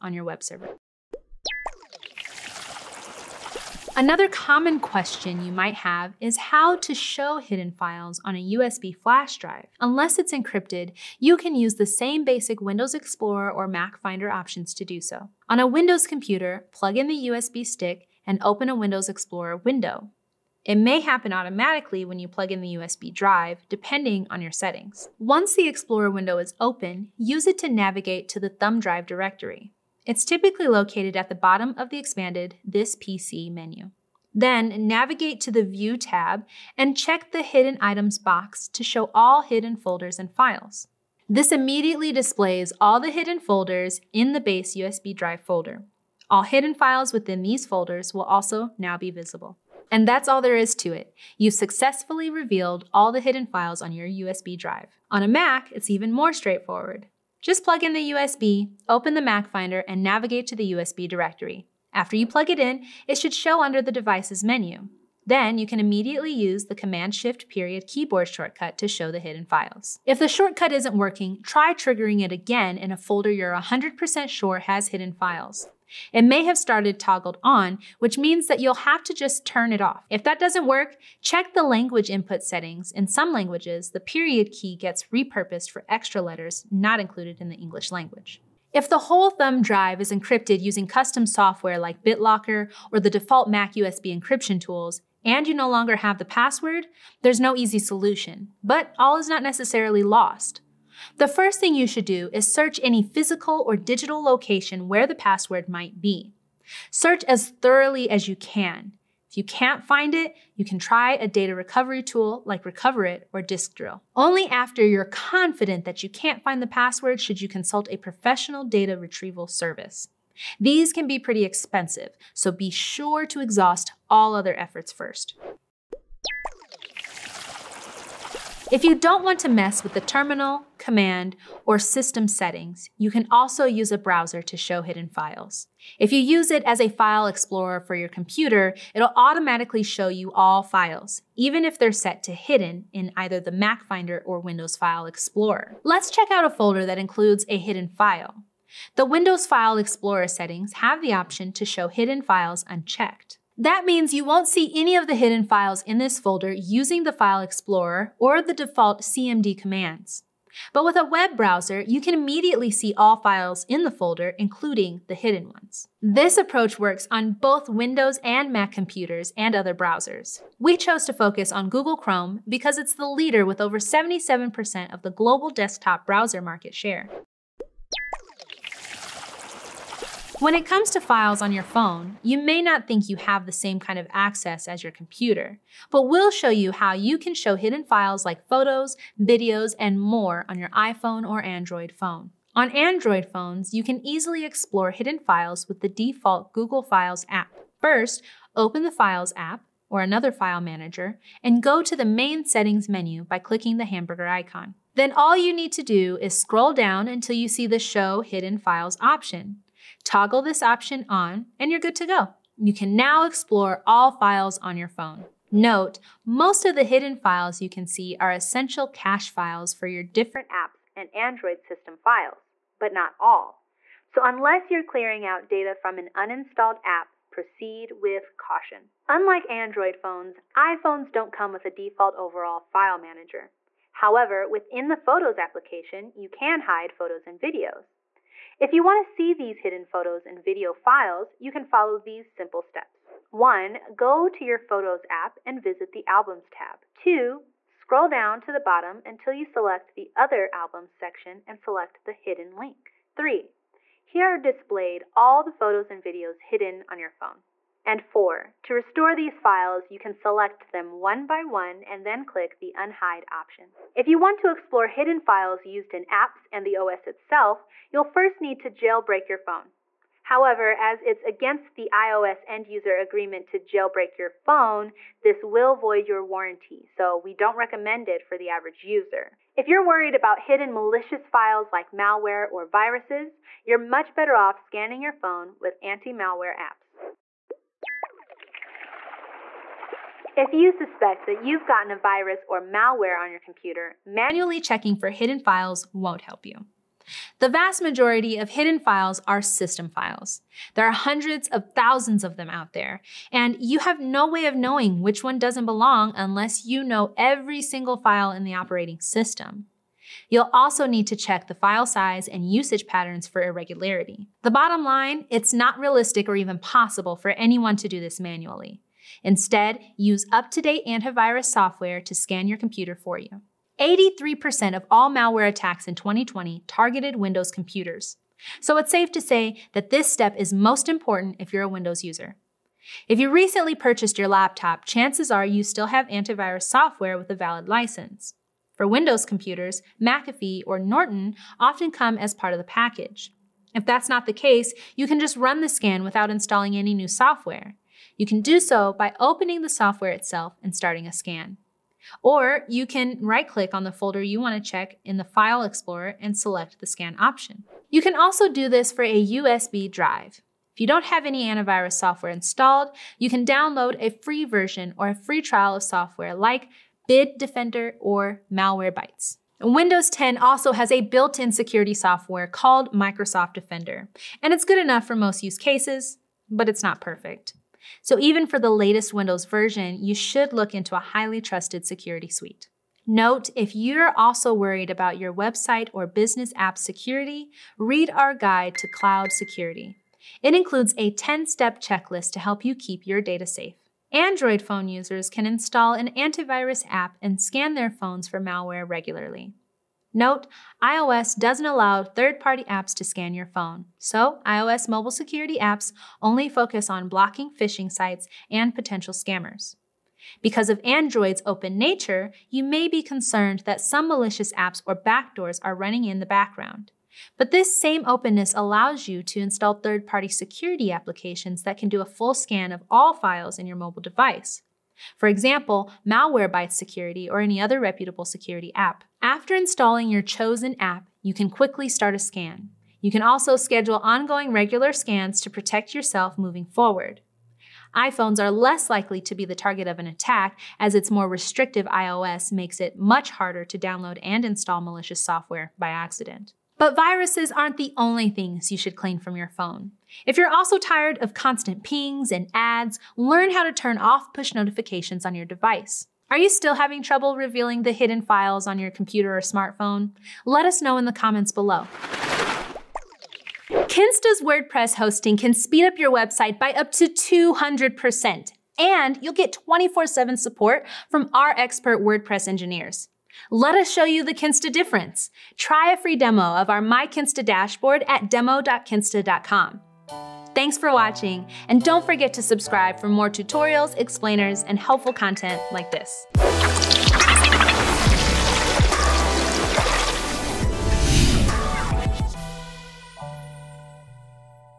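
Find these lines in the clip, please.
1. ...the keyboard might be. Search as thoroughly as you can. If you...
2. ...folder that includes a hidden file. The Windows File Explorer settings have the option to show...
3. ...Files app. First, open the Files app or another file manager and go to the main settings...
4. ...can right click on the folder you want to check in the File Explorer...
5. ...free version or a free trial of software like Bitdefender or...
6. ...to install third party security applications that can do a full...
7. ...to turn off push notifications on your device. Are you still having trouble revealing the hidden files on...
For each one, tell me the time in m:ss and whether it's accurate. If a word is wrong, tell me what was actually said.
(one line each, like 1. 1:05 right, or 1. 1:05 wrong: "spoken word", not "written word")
1. 1:45 wrong: "password", not "keyboard"
2. 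2:26 right
3. 3:16 right
4. 5:52 right
5. 6:04 right
6. 6:59 right
7. 7:33 right.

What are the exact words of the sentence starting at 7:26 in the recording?
But viruses aren't the only things you should clean from your phone.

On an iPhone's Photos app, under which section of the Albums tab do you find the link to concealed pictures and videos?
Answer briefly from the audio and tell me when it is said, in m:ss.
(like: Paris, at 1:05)
Other Albums, at 4:10.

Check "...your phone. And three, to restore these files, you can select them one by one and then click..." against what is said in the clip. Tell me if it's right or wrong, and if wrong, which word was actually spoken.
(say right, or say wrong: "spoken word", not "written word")
wrong: "four", not "three".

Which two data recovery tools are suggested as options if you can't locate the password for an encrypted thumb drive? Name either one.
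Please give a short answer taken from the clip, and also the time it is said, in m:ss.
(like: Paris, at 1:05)
Recoverit or Disk Drill, at 1:52.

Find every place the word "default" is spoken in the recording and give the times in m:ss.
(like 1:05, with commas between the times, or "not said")
1:33, 2:38, 3:15, 3:51.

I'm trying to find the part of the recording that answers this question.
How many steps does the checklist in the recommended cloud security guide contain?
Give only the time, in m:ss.
6:31.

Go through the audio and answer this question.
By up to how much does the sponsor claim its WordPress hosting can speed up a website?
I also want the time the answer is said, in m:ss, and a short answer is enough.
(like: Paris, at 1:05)
200%, at 7:47.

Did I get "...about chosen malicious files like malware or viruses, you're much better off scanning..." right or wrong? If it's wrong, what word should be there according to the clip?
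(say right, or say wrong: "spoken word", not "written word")
wrong: "hidden", not "chosen".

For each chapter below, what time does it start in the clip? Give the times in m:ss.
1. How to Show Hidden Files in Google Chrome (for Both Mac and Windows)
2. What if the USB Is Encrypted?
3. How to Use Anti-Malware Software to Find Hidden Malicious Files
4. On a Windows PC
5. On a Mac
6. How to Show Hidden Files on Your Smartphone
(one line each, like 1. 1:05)
1. 2:10
2. 1:30
3. 4:50
4. 0:17
5. 0:56
6. 3:01.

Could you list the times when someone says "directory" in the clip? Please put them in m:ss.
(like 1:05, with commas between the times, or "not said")
0:29, 1:01.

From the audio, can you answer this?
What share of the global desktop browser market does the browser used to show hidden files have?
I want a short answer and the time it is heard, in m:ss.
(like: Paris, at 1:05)
over 77%, at 2:53.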